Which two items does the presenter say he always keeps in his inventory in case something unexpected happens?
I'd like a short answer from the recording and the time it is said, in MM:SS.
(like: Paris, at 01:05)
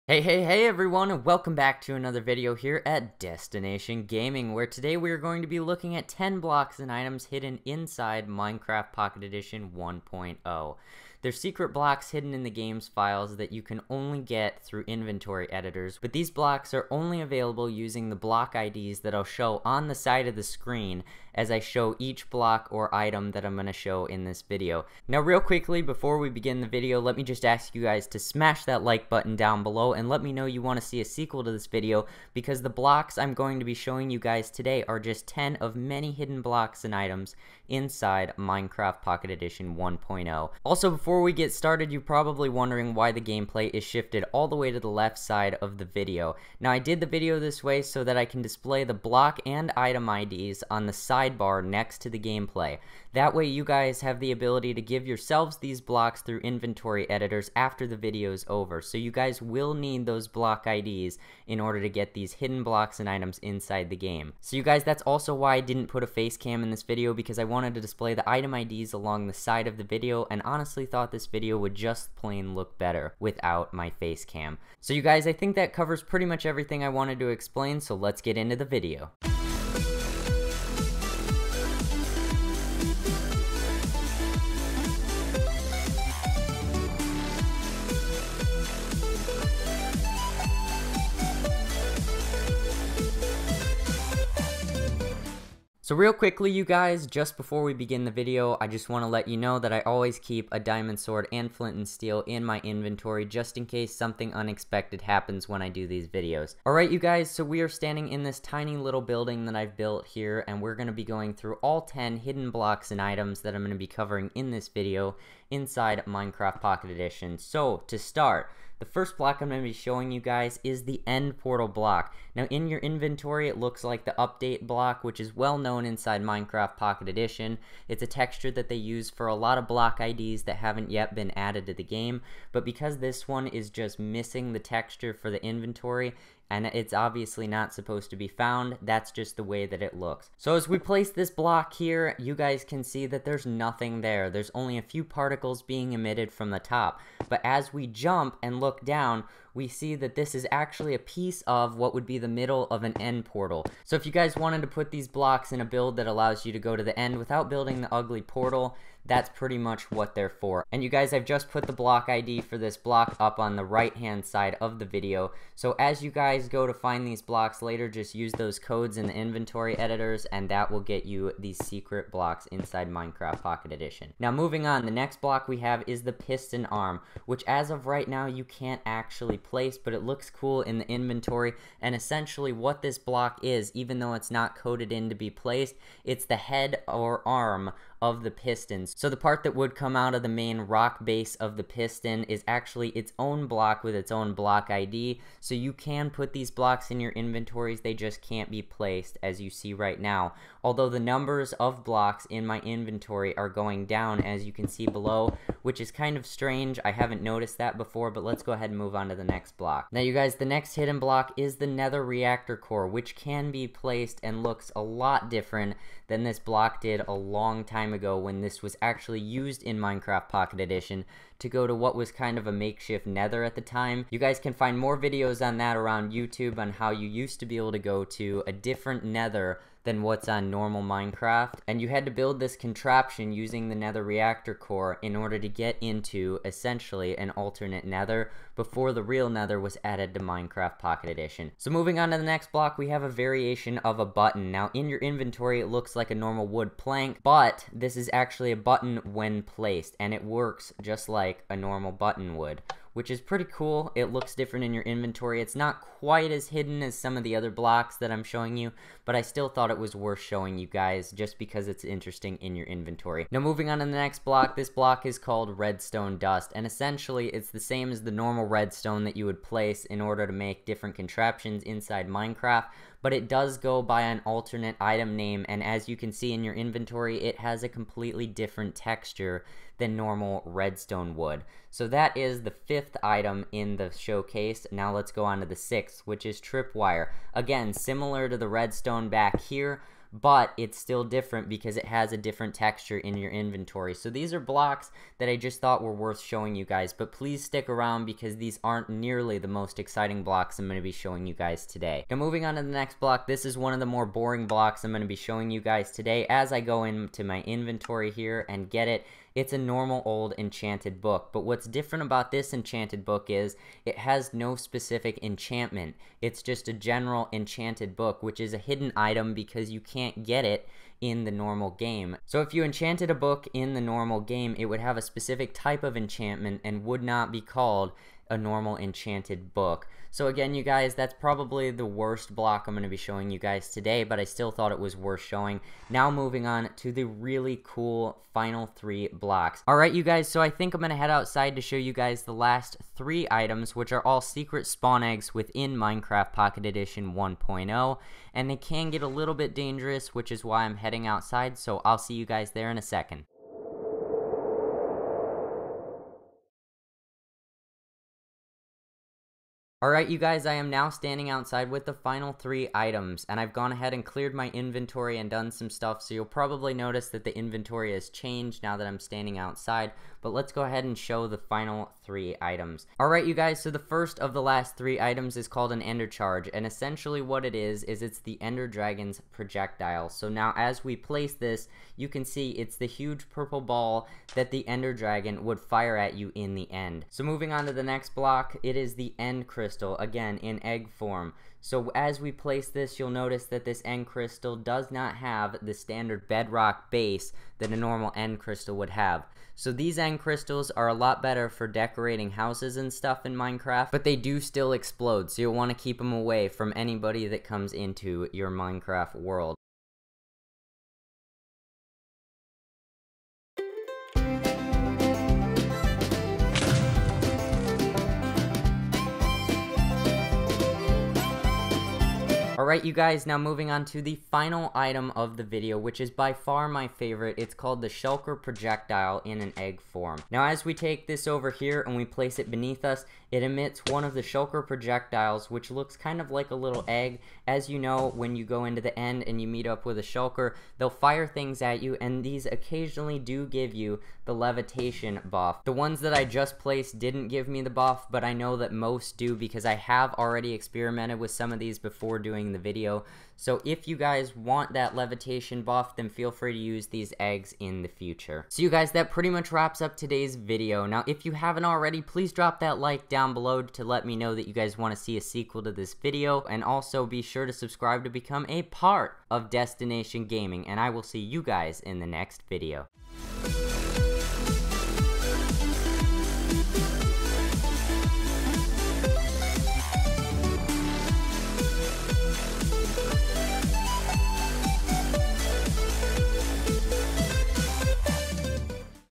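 Diamond sword and flint and steel, at 01:40.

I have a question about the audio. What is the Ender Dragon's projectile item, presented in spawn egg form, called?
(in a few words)
Ender Charge.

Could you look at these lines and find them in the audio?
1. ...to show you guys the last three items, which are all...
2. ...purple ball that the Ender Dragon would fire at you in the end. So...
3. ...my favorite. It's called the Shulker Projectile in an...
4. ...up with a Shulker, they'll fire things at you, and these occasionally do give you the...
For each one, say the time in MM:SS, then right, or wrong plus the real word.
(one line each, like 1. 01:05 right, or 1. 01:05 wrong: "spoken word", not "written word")
1. 05:41 right
2. 06:23 right
3. 07:06 right
4. 07:19 right.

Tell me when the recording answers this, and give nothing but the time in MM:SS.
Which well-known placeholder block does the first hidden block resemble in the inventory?
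02:04.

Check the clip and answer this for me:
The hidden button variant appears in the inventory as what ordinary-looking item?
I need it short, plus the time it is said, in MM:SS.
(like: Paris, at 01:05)
Wood plank, at 04:06.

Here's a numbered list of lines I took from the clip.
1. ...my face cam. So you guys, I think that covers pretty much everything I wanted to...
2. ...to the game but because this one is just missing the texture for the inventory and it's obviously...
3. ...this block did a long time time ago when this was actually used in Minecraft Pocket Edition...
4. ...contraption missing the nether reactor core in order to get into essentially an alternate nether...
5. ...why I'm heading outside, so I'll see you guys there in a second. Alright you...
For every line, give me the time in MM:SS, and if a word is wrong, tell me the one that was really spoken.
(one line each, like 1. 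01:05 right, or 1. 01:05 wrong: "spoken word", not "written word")
1. 01:13 right
2. 02:11 right
3. 03:36 right
4. 03:52 wrong: "using", not "missing"
5. 05:50 right.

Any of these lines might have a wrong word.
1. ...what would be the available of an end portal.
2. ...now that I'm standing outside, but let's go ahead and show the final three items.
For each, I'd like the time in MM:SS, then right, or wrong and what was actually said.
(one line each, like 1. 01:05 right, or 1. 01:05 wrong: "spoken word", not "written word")
1. 02:31 wrong: "middle", not "available"
2. 06:08 right.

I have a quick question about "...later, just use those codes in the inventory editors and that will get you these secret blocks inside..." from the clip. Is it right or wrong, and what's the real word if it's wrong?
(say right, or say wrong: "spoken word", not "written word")
right.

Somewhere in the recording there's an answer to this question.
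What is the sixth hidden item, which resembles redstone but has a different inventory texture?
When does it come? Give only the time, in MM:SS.
04:46.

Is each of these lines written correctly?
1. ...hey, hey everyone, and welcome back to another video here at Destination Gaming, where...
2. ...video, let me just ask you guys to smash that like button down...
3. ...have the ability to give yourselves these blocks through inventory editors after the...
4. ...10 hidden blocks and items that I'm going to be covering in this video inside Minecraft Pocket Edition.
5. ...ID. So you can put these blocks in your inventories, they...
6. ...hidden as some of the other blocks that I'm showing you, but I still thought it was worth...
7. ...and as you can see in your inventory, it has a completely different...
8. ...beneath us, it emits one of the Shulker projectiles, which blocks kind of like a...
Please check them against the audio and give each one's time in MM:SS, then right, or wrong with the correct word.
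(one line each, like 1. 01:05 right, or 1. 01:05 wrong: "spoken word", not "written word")
1. 00:00 right
2. 00:26 right
3. 00:53 right
4. 01:51 right
5. 03:14 right
6. 04:16 right
7. 04:35 right
8. 07:12 wrong: "looks", not "blocks".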